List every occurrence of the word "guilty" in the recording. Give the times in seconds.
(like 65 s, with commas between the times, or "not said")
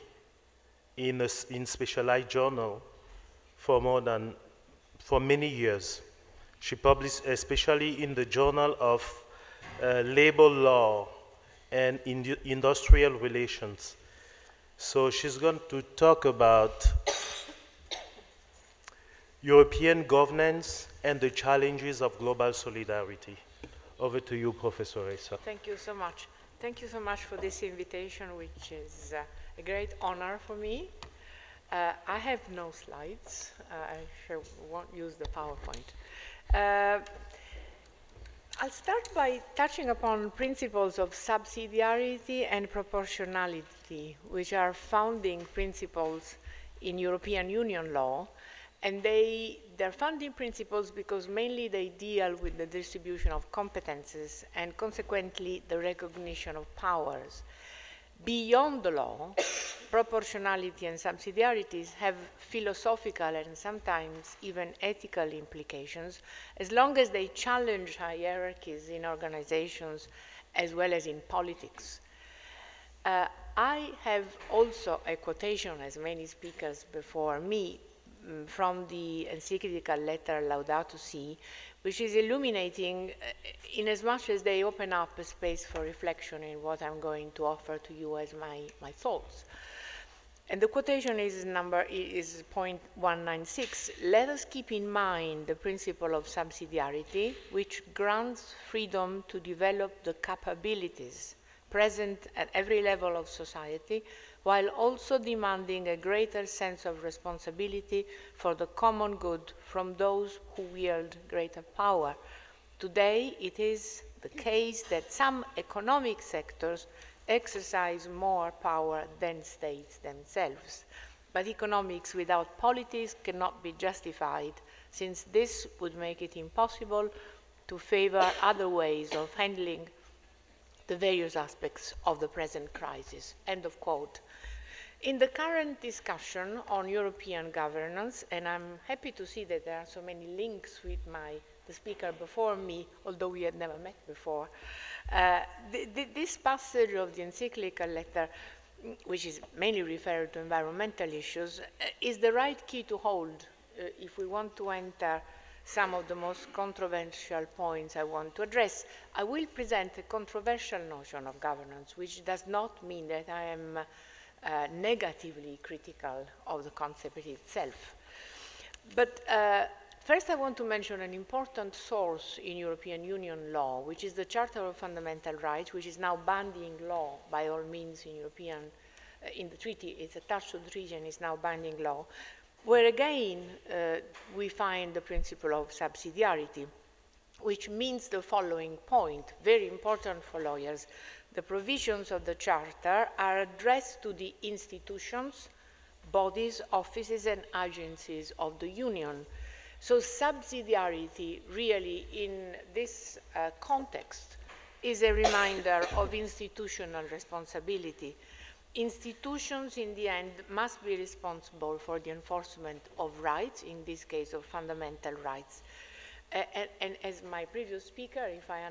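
not said.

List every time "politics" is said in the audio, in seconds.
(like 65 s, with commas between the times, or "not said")
71 s, 122 s.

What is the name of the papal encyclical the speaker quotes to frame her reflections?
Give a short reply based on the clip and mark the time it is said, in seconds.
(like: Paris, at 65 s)
Laudato Si, at 80 s.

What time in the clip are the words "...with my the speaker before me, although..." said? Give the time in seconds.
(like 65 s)
140 s.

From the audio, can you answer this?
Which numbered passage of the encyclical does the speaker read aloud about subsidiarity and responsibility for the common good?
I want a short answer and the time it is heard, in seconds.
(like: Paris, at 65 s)
196, at 92 s.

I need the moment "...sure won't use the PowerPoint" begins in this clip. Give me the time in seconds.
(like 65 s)
34 s.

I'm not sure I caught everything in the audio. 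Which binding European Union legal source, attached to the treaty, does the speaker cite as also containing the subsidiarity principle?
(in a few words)
Charter of Fundamental Rights.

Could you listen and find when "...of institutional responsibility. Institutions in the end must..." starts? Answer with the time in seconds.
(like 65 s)
205 s.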